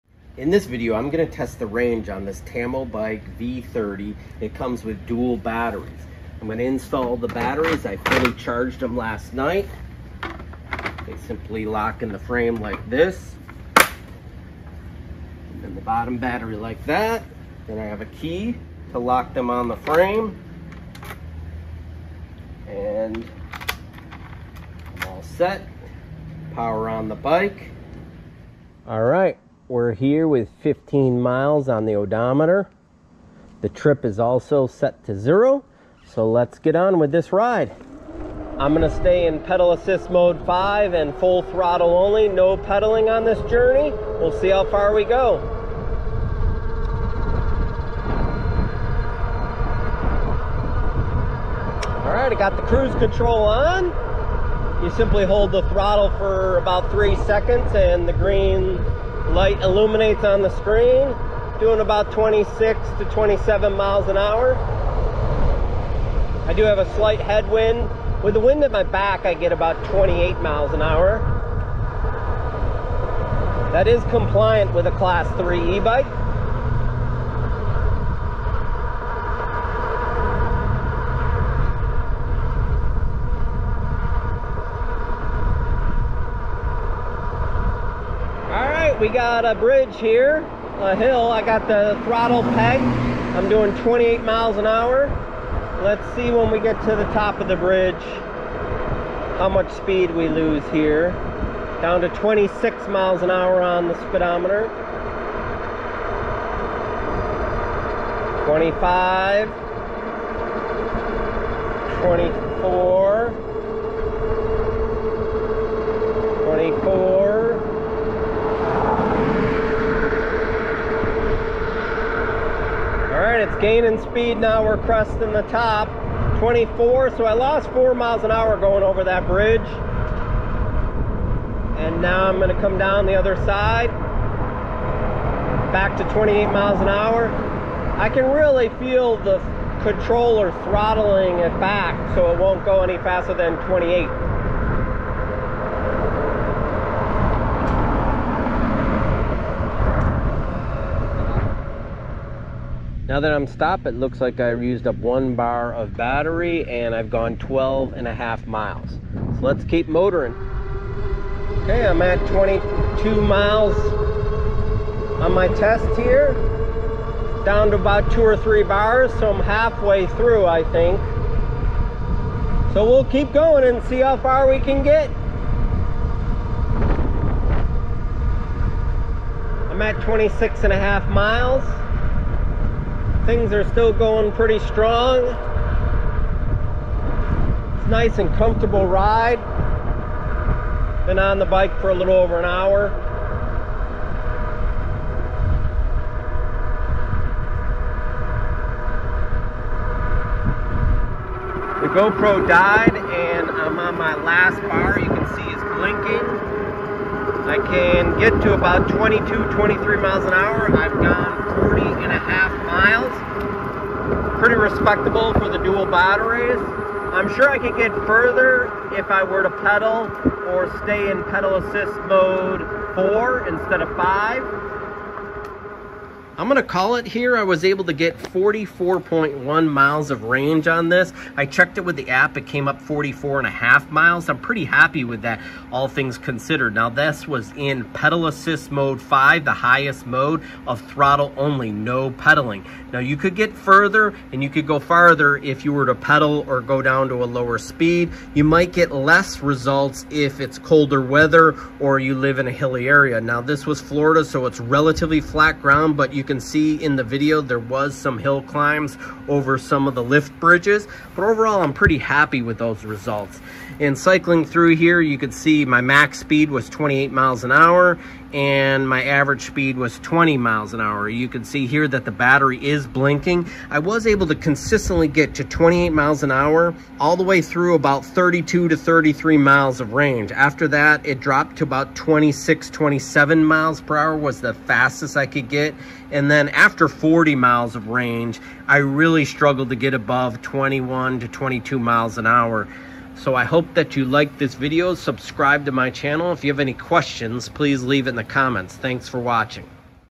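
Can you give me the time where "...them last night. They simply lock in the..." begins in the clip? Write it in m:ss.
0:08.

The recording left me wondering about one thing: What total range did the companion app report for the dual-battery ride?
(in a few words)
44.5 miles.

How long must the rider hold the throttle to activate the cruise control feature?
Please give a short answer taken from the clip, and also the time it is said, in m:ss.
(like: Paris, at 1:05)
3 seconds, at 0:56.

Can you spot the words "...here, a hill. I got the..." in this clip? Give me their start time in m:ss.
1:29.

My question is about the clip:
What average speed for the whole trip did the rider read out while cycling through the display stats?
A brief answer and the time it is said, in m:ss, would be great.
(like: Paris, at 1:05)
20 mph, at 4:29.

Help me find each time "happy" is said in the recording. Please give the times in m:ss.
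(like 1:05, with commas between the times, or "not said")
3:54, 4:21.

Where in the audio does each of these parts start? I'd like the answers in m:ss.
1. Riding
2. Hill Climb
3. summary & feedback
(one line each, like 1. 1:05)
1. 0:42
2. 1:29
3. 3:46.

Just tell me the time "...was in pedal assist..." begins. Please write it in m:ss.
3:57.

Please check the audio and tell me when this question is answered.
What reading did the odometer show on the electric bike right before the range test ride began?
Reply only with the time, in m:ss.
0:30.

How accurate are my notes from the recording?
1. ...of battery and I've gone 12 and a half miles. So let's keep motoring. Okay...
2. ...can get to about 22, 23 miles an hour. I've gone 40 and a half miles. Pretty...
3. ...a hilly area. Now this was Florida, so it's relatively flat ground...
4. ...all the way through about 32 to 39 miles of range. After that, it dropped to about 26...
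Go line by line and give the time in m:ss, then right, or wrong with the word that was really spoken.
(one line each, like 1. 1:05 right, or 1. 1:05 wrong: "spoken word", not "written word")
1. 2:35 right
2. 3:27 right
3. 4:12 right
4. 4:37 wrong: "33", not "39".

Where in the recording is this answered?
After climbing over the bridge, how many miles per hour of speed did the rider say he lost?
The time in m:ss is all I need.
2:07.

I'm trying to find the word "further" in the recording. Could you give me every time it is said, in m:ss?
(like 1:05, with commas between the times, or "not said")
3:38, 4:03.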